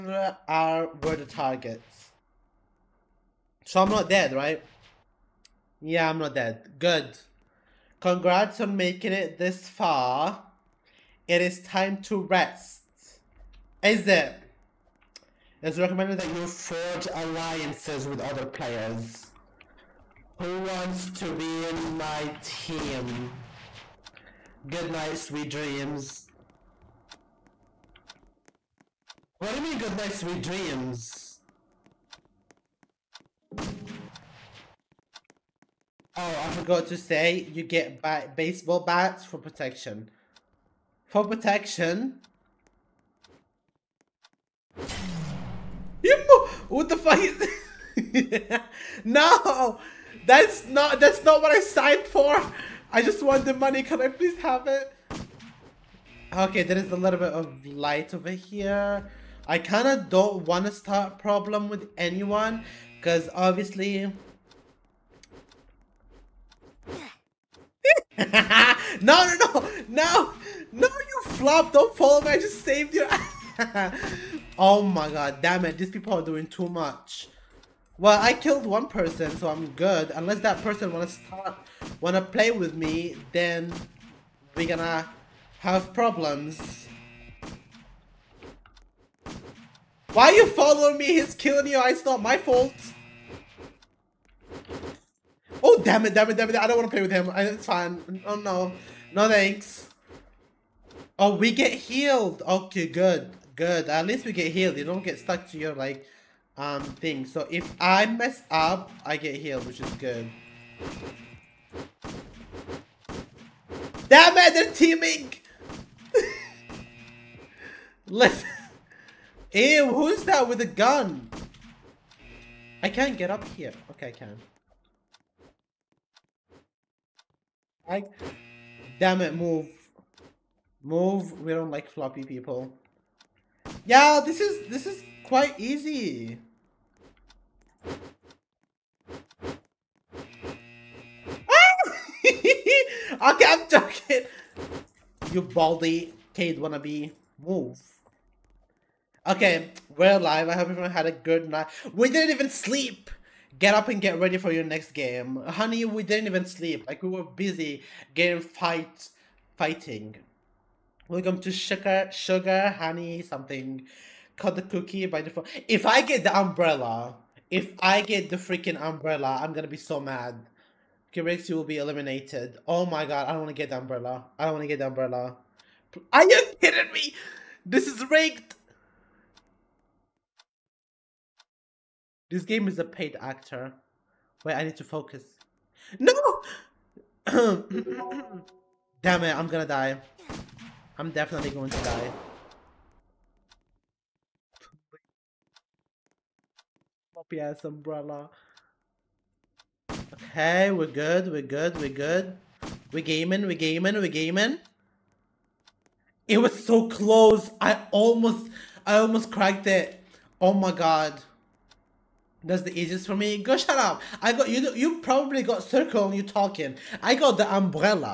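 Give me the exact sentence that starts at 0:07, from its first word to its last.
Congrats on making it this far.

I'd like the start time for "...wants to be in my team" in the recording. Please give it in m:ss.
0:20.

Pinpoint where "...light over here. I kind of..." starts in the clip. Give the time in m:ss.
0:57.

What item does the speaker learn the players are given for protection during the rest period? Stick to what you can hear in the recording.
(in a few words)
baseball bats.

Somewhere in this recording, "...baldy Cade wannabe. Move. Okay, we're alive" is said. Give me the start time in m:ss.
2:25.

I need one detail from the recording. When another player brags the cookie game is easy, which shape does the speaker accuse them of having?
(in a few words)
circle.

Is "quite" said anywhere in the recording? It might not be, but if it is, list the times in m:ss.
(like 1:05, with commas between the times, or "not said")
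2:15.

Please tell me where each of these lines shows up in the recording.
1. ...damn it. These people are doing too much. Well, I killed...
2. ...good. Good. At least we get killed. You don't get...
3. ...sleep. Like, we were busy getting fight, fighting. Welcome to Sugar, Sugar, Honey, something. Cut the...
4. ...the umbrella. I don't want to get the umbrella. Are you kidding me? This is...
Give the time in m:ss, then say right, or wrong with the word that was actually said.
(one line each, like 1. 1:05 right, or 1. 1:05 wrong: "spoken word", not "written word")
1. 1:15 right
2. 1:42 wrong: "healed", not "killed"
3. 2:36 right
4. 2:53 right.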